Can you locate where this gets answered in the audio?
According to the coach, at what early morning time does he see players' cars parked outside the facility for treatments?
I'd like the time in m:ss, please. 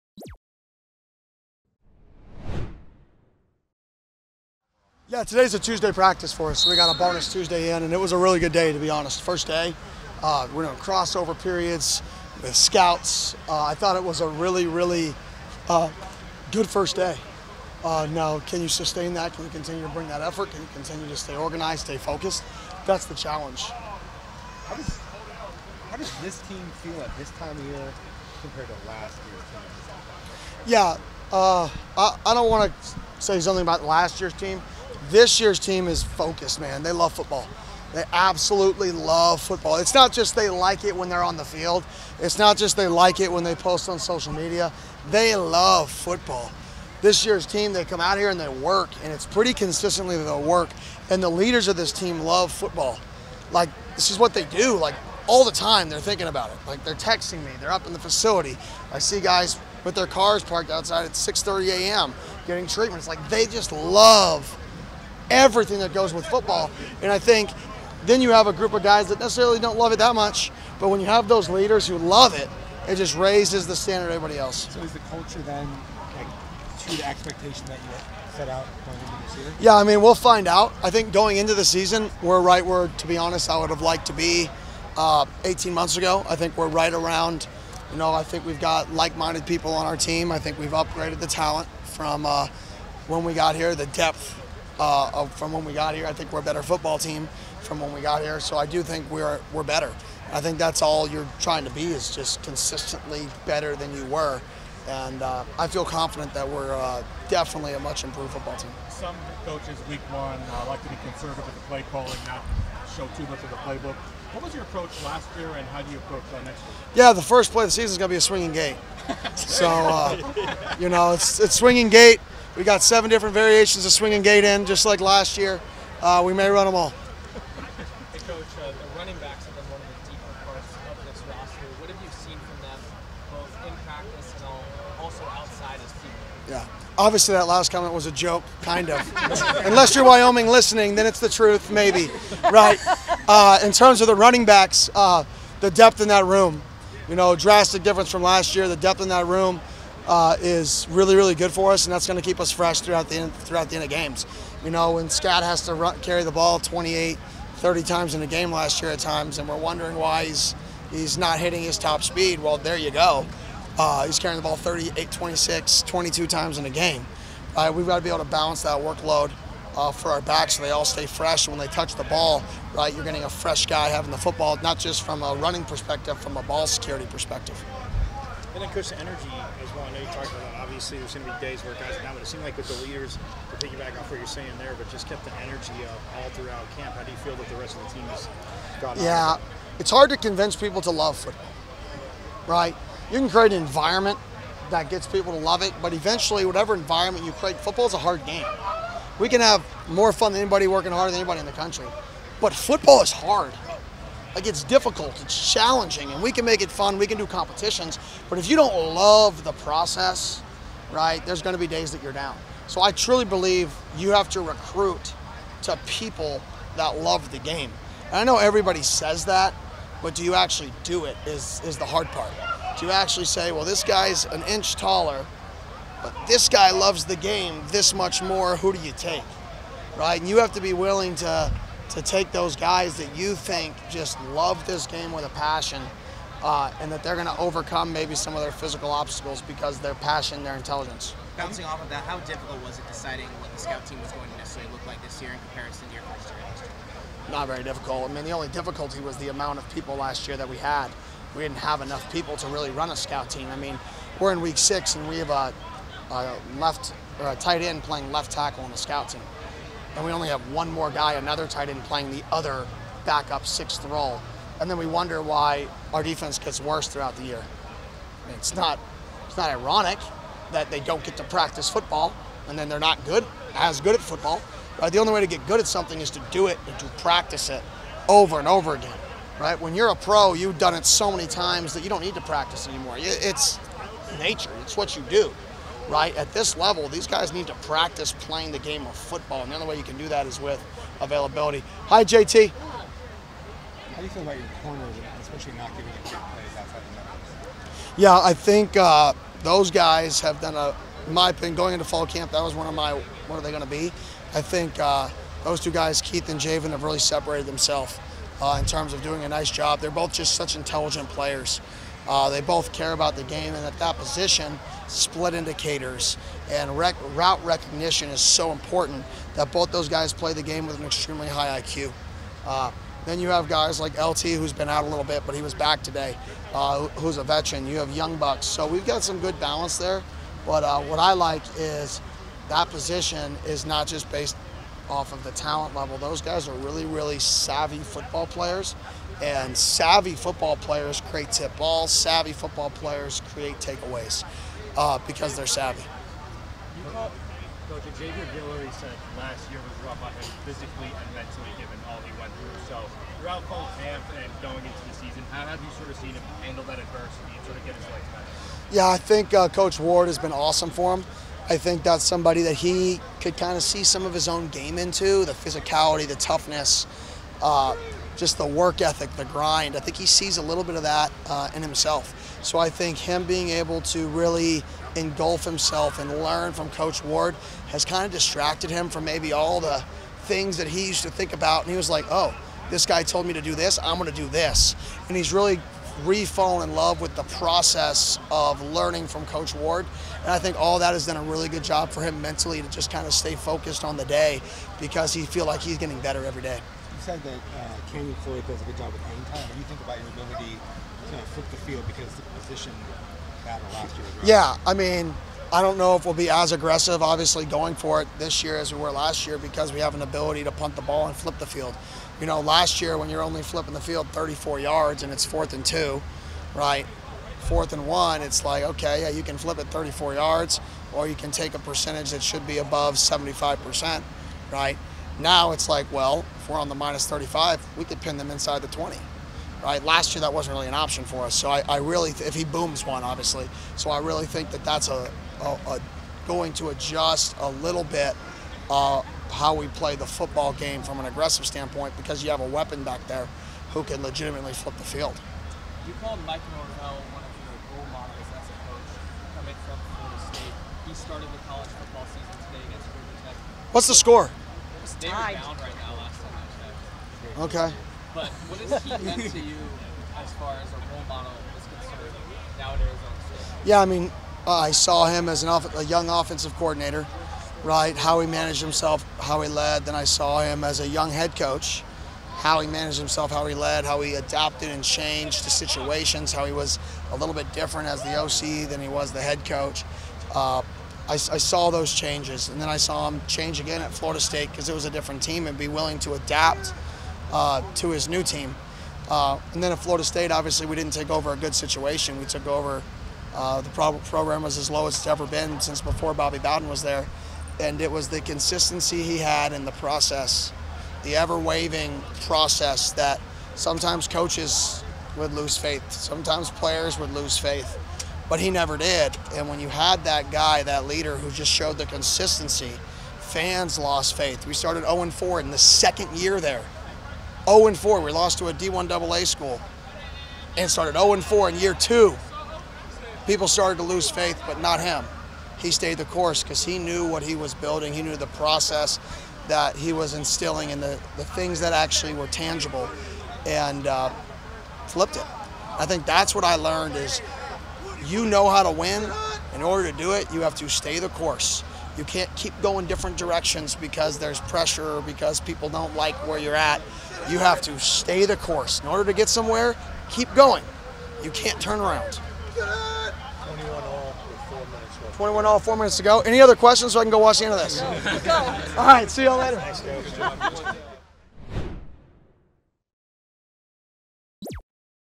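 1:01.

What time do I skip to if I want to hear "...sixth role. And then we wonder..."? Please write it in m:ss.
4:23.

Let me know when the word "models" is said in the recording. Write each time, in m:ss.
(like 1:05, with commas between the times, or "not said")
7:27, 7:41.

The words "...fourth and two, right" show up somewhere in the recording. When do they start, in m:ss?
6:55.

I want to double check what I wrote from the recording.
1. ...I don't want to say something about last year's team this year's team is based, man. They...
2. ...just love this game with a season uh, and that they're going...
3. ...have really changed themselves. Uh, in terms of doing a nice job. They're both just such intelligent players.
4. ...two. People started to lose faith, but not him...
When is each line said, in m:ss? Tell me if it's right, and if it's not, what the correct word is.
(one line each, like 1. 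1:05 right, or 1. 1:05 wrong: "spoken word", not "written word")
1. 0:32 wrong: "focused", not "based"
2. 3:53 wrong: "passion", not "season"
3. 5:06 wrong: "separated", not "changed"
4. 8:41 right.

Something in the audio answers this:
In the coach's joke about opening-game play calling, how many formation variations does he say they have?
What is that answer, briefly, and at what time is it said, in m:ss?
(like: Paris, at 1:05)
7, at 2:02.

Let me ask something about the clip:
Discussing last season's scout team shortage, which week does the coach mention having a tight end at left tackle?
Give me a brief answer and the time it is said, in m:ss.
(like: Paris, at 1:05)
Week 6, at 4:14.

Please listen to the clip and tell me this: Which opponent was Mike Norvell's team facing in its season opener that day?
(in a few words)
Georgia Tech.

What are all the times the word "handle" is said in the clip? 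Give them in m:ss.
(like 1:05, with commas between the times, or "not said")
5:56.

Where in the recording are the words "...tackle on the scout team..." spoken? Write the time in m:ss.
4:18.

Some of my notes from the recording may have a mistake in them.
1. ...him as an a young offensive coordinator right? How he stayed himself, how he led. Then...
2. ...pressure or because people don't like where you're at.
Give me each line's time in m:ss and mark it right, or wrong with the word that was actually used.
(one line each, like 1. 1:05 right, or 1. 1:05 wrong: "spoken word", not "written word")
1. 7:45 wrong: "managed", not "stayed"
2. 9:04 right.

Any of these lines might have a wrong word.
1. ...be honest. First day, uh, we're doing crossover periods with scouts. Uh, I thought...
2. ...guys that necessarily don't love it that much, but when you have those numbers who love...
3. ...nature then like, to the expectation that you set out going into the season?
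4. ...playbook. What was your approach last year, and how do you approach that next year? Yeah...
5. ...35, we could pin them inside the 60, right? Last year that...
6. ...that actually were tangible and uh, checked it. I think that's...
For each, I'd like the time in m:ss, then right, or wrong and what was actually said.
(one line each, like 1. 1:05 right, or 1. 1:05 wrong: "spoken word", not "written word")
1. 0:08 right
2. 1:08 wrong: "leaders", not "numbers"
3. 1:14 wrong: "culture", not "nature"
4. 1:53 right
5. 7:07 wrong: "20", not "60"
6. 8:51 wrong: "flipped", not "checked".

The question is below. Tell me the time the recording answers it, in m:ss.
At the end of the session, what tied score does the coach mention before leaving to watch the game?
9:15.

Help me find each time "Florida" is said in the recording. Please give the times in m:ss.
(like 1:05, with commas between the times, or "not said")
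7:29, 8:03, 8:09.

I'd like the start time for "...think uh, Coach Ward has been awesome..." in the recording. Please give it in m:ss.
5:58.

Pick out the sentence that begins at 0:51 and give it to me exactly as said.
And the leaders of this team love football.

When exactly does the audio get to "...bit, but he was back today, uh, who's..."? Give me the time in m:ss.
5:25.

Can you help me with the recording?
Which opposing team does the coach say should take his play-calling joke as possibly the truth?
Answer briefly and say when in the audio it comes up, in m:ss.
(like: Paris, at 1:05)
Wyoming, at 2:20.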